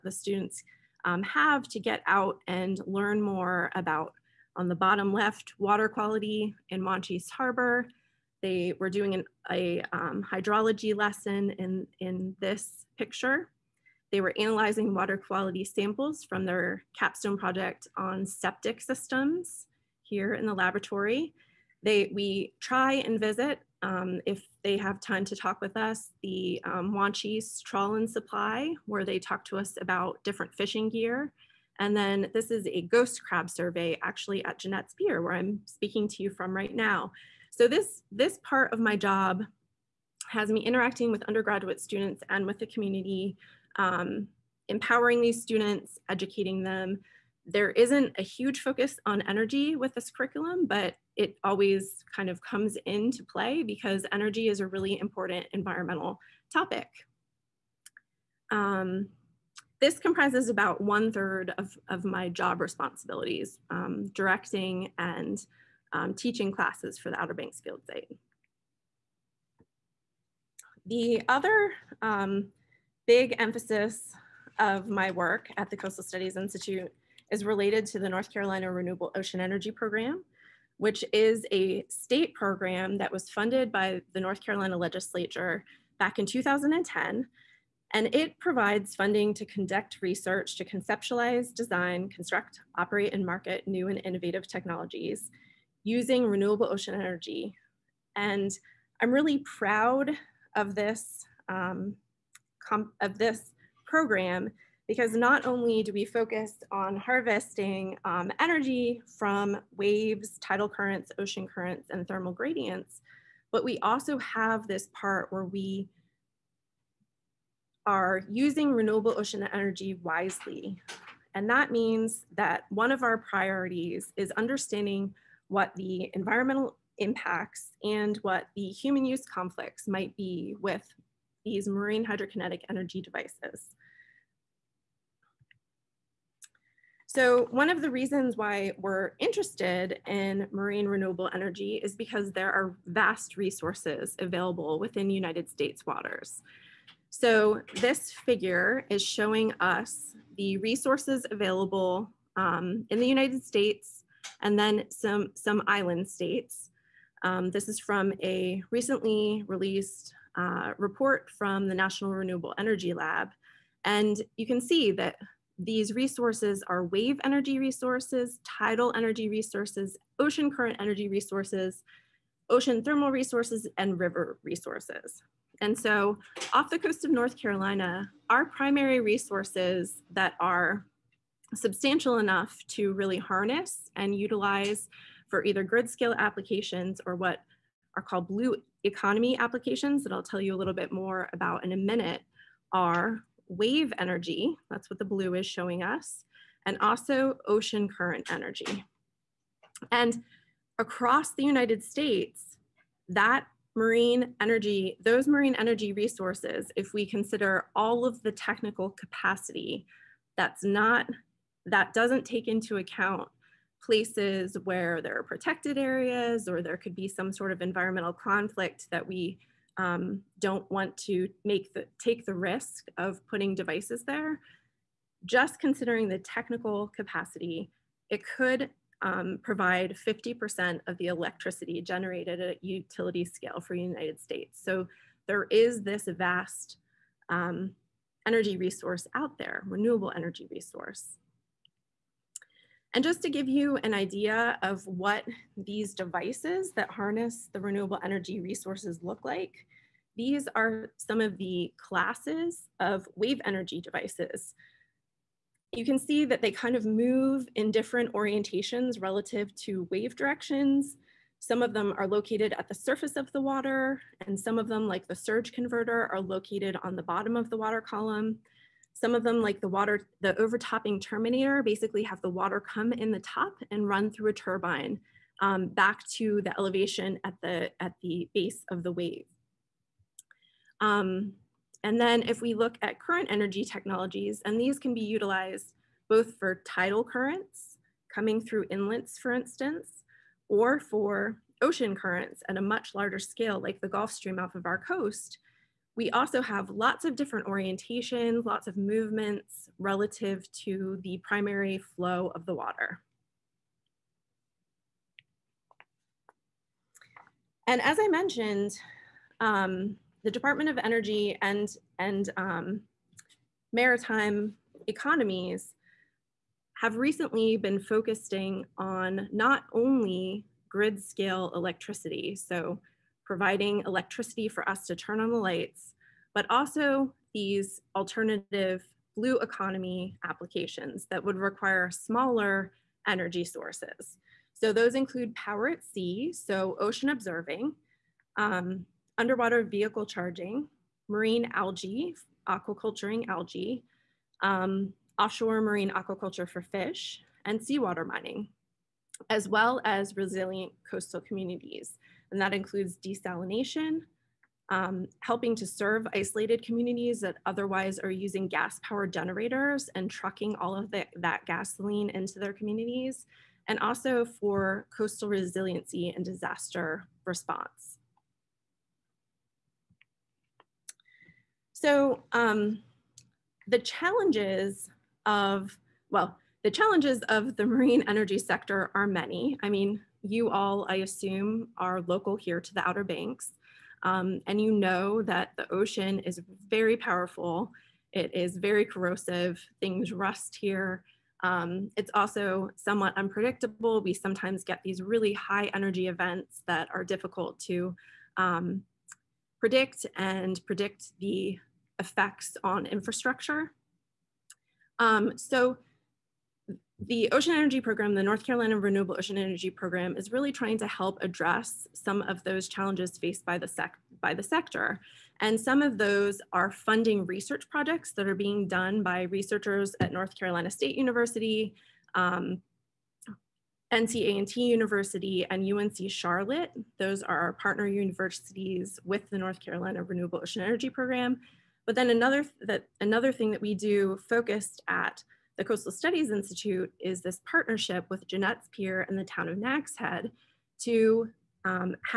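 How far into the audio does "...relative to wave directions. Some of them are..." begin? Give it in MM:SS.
04:18.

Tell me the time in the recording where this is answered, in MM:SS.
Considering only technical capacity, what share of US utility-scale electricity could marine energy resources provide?
03:50.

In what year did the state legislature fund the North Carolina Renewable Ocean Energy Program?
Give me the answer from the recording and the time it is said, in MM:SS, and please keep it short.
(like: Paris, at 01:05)
2010, at 01:26.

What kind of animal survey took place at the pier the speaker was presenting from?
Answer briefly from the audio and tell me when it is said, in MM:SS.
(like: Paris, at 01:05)
ghost crab survey, at 00:32.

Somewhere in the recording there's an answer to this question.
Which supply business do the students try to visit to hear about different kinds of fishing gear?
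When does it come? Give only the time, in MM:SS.
00:26.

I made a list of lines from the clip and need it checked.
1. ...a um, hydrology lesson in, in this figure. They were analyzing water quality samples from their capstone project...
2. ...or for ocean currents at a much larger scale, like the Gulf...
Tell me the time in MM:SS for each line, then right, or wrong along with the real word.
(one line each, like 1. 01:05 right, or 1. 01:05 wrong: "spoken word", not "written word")
1. 00:09 wrong: "picture", not "figure"
2. 04:50 right.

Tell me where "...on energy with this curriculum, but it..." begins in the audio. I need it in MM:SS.
00:49.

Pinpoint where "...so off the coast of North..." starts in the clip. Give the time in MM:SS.
02:55.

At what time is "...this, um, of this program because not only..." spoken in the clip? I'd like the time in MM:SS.
01:40.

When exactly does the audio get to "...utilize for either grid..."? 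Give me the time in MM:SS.
03:04.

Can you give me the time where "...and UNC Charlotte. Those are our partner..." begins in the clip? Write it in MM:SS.
07:05.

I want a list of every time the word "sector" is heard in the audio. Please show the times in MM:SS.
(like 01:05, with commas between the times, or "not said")
06:18, 06:54.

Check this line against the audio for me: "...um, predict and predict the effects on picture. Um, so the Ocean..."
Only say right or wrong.
wrong.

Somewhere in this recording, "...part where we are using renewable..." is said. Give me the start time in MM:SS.
01:54.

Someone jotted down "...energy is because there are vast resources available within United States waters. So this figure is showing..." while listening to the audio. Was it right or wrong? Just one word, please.
right.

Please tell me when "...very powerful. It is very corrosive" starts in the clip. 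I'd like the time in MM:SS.
06:26.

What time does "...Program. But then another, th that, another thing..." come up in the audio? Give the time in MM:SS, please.
07:10.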